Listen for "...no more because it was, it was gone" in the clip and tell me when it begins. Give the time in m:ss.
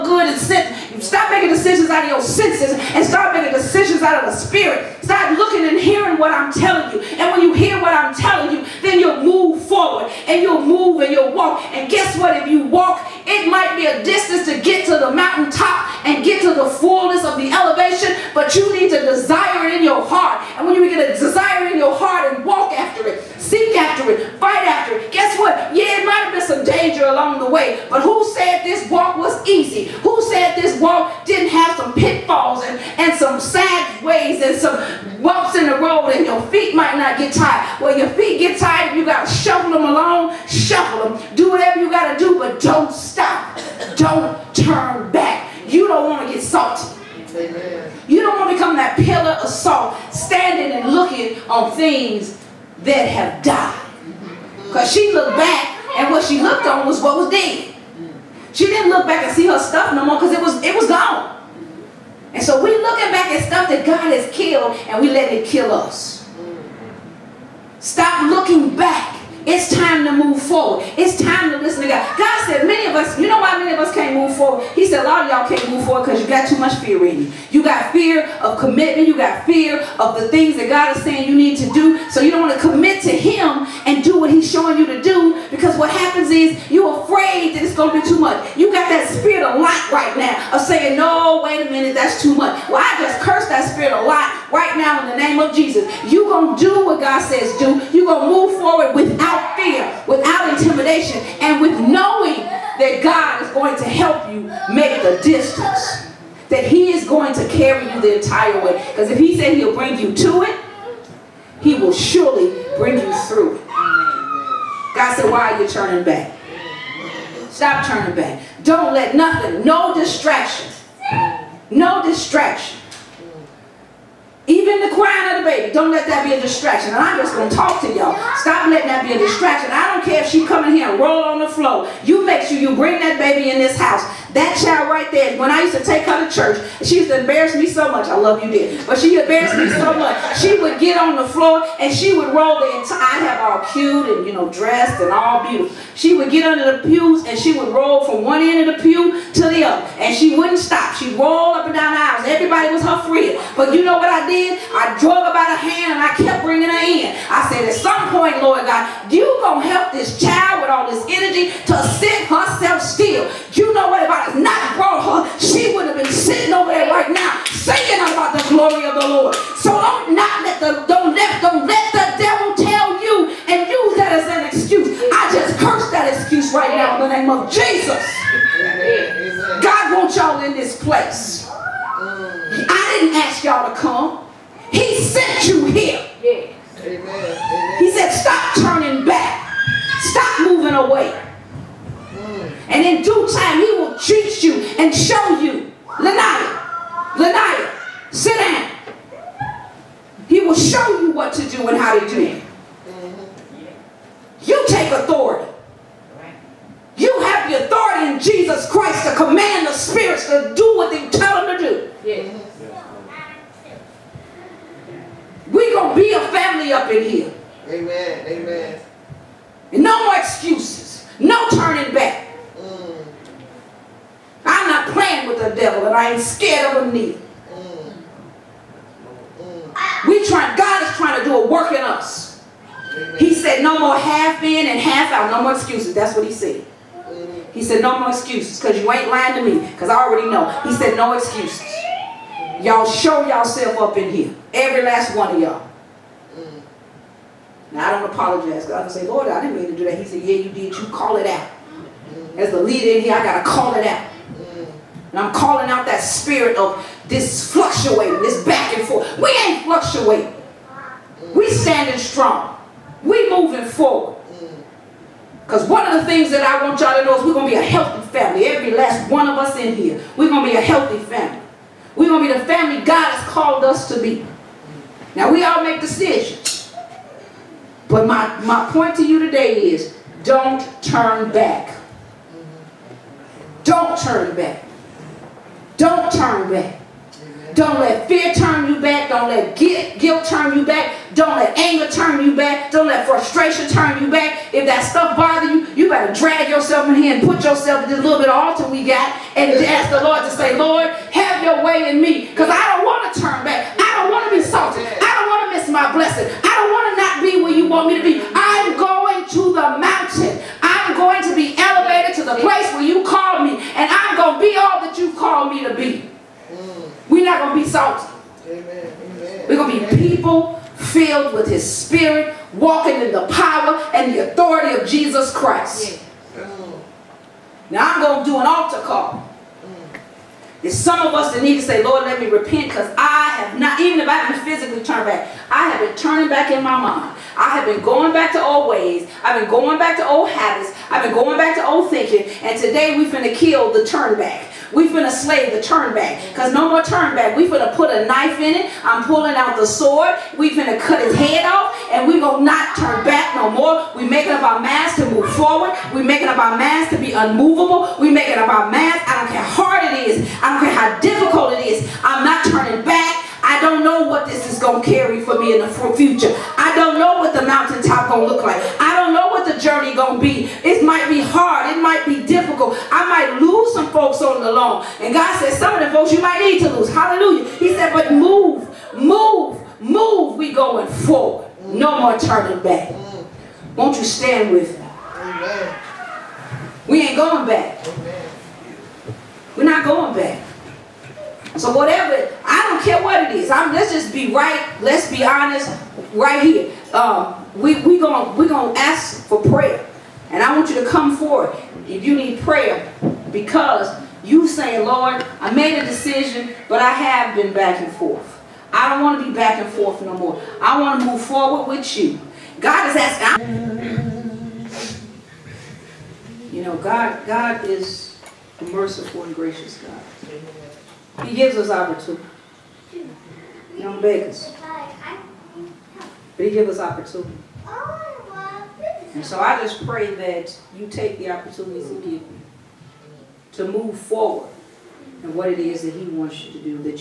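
0:59.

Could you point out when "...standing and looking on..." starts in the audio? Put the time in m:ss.
0:50.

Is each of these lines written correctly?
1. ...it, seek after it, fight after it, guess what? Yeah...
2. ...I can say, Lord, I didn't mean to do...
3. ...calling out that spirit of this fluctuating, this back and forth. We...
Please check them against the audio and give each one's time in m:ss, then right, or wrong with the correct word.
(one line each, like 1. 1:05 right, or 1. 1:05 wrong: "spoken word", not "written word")
1. 0:23 right
2. 4:08 right
3. 4:15 right.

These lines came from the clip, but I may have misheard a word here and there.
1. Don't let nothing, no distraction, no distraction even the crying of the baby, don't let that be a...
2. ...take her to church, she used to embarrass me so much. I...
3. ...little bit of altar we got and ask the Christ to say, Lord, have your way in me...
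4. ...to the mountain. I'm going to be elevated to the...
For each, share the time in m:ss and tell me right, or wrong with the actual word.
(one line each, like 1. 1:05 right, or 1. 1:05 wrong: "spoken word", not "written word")
1. 1:58 right
2. 2:15 right
3. 4:57 wrong: "Lord", not "Christ"
4. 5:09 right.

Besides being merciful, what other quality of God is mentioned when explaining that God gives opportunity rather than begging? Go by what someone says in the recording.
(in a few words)
gracious.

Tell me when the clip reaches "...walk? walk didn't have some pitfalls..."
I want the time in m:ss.
0:30.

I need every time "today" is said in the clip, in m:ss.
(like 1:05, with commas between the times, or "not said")
4:39, 5:42.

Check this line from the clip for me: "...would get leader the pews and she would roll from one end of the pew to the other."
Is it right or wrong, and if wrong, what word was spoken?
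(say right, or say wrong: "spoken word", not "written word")
wrong: "under", not "leader".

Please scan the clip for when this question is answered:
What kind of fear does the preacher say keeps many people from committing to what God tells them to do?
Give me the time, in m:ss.
1:17.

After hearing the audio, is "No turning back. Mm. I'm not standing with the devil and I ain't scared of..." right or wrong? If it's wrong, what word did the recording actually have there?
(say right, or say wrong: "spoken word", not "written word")
wrong: "playing", not "standing".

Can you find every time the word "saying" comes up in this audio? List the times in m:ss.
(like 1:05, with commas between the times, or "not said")
1:21, 1:30, 6:44.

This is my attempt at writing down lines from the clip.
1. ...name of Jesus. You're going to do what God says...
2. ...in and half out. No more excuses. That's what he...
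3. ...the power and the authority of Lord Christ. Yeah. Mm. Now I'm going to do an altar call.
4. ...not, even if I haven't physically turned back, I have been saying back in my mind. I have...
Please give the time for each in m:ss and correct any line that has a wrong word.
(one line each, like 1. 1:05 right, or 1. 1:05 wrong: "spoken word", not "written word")
1. 1:35 right
2. 3:54 right
3. 5:23 wrong: "Jesus", not "Lord"
4. 5:33 wrong: "turning", not "saying".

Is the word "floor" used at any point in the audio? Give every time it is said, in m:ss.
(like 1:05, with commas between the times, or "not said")
2:11, 2:21.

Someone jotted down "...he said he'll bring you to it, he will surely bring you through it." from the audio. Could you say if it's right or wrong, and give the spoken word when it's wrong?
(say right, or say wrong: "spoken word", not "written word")
right.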